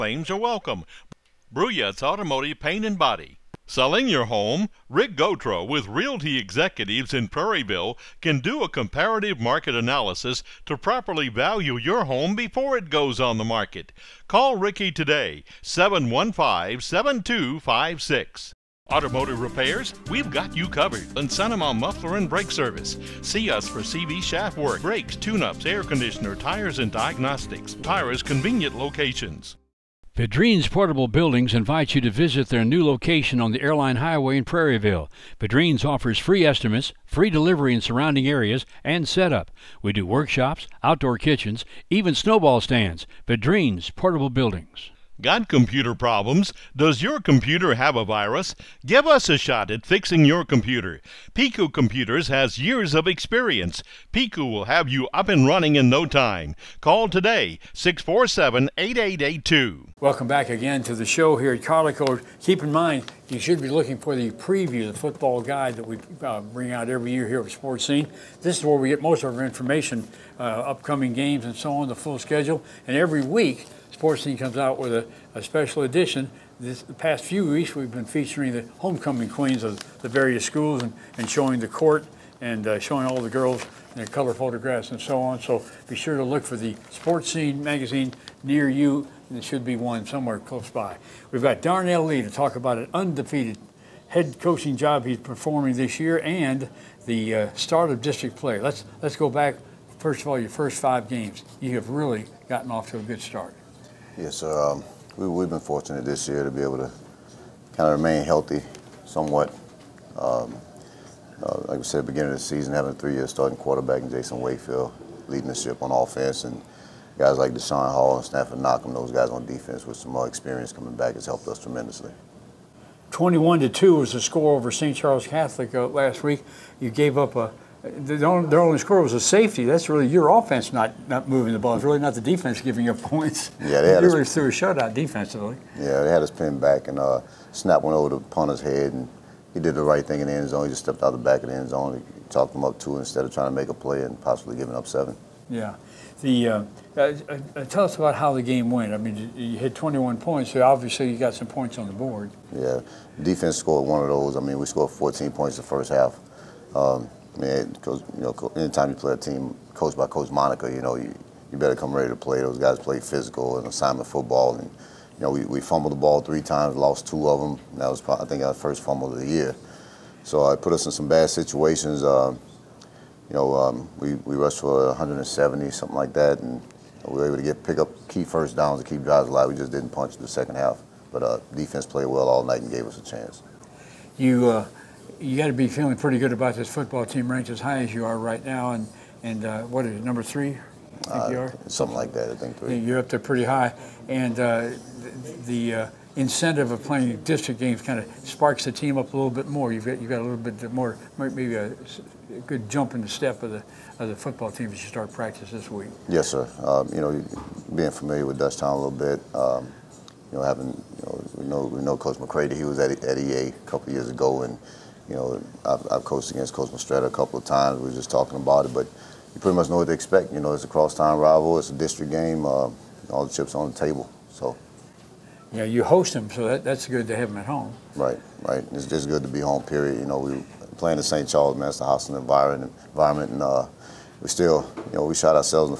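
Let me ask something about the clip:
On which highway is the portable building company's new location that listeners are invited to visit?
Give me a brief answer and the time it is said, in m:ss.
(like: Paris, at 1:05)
Airline Highway, at 0:33.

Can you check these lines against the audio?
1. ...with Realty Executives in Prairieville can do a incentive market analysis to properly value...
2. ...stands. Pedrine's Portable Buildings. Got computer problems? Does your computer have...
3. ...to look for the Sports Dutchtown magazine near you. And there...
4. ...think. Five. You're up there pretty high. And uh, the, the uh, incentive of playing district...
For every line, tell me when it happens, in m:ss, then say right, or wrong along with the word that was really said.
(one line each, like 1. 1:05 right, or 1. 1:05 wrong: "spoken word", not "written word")
1. 0:05 wrong: "comparative", not "incentive"
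2. 0:42 right
3. 1:26 wrong: "Scene", not "Dutchtown"
4. 3:12 wrong: "Three", not "Five".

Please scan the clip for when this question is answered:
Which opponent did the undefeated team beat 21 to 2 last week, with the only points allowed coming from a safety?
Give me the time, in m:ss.
2:04.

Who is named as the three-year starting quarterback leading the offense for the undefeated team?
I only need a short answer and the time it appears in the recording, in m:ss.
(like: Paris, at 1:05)
Jason Wakefield, at 1:54.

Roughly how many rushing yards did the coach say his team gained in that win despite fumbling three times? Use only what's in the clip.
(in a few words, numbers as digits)
170.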